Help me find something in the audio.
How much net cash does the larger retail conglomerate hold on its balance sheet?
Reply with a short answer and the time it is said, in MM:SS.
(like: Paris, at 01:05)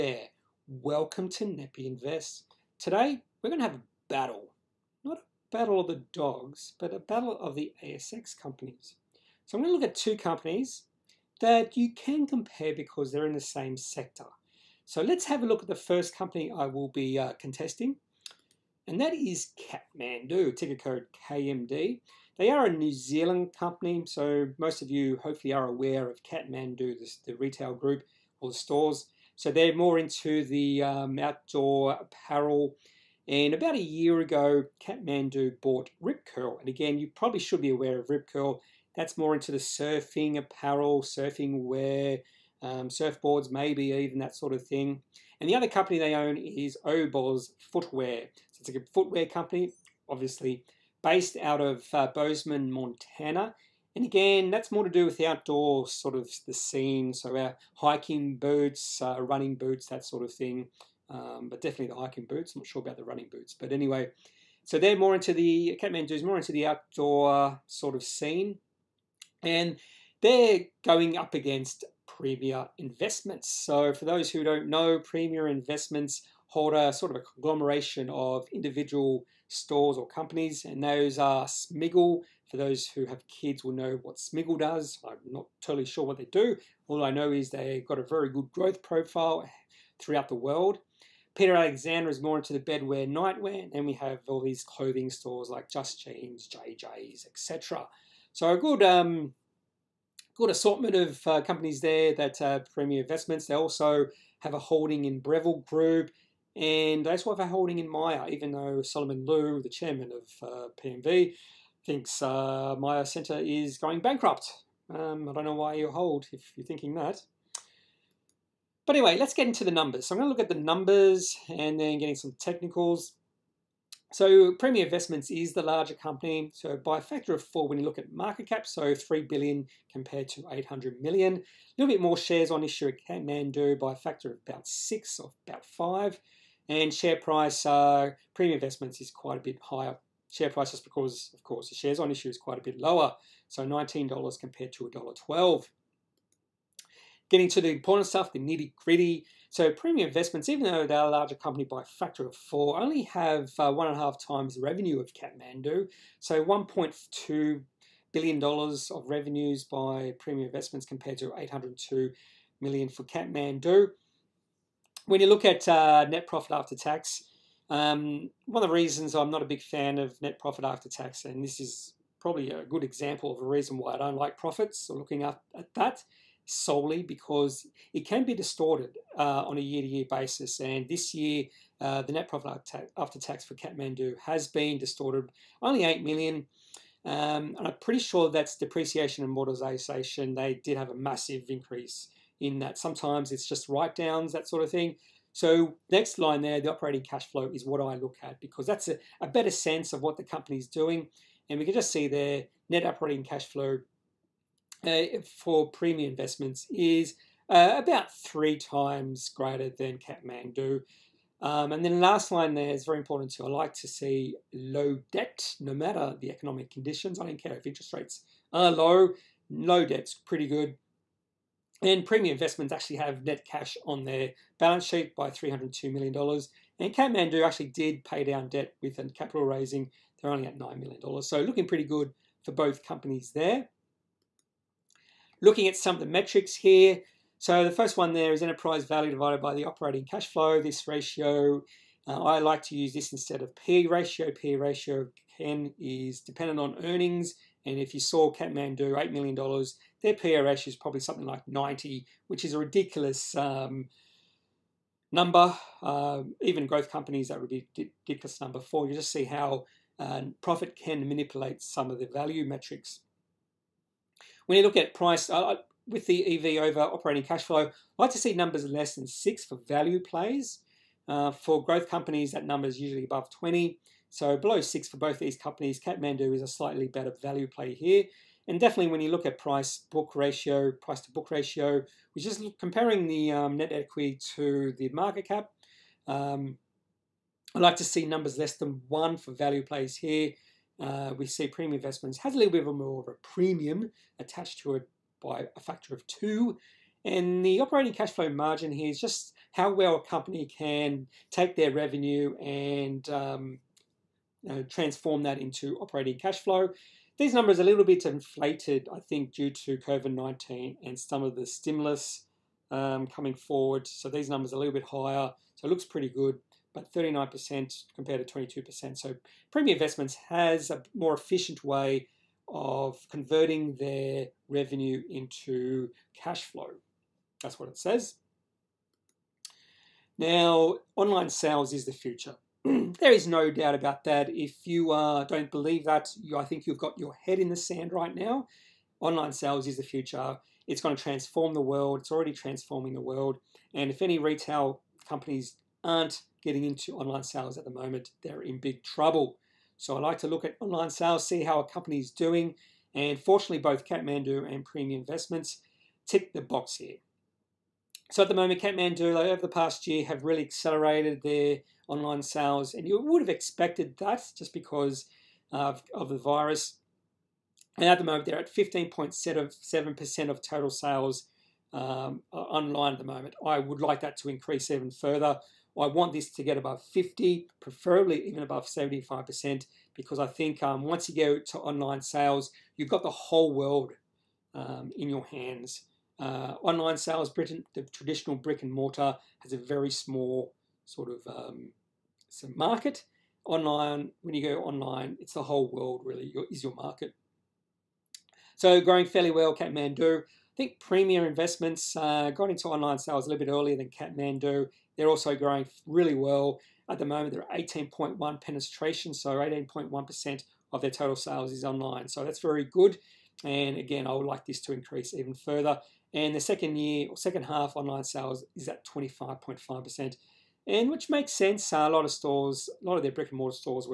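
$302 million, at 03:45.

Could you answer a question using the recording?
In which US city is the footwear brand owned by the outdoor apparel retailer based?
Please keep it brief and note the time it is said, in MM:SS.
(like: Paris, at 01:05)
Bozeman, Montana, at 00:52.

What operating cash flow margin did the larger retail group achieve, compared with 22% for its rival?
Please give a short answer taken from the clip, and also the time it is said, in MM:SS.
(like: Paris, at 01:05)
39%, at 05:16.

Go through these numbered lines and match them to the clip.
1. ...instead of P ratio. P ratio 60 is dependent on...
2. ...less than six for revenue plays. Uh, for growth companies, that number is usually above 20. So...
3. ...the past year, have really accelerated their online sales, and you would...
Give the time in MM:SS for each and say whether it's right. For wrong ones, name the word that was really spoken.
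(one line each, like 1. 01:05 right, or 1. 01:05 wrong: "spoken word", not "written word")
1. 04:03 wrong: "10", not "60"
2. 04:28 wrong: "value", not "revenue"
3. 05:59 right.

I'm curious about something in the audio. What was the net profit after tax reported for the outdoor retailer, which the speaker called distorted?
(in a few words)
$8 million.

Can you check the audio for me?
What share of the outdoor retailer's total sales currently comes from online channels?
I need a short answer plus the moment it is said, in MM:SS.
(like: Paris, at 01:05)
15.7%, at 06:08.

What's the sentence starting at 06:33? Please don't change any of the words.
Online, when you go online, it's the whole world really your, is your market.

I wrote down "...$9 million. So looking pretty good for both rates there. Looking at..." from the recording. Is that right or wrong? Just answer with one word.
wrong.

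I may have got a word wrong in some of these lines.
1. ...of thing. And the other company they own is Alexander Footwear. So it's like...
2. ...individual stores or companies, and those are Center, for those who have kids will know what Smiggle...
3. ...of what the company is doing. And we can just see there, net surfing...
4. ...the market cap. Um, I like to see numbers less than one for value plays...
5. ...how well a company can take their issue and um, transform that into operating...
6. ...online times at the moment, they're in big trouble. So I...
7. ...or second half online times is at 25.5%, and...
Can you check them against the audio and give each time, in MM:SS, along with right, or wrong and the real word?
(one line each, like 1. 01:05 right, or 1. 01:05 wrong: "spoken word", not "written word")
1. 00:44 wrong: "Oboz", not "Alexander"
2. 01:18 wrong: "Smiggle", not "Center"
3. 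03:19 wrong: "operating", not "surfing"
4. 04:44 right
5. 04:59 wrong: "revenue", not "issue"
6. 05:46 wrong: "sales", not "times"
7. 06:57 wrong: "sales", not "times".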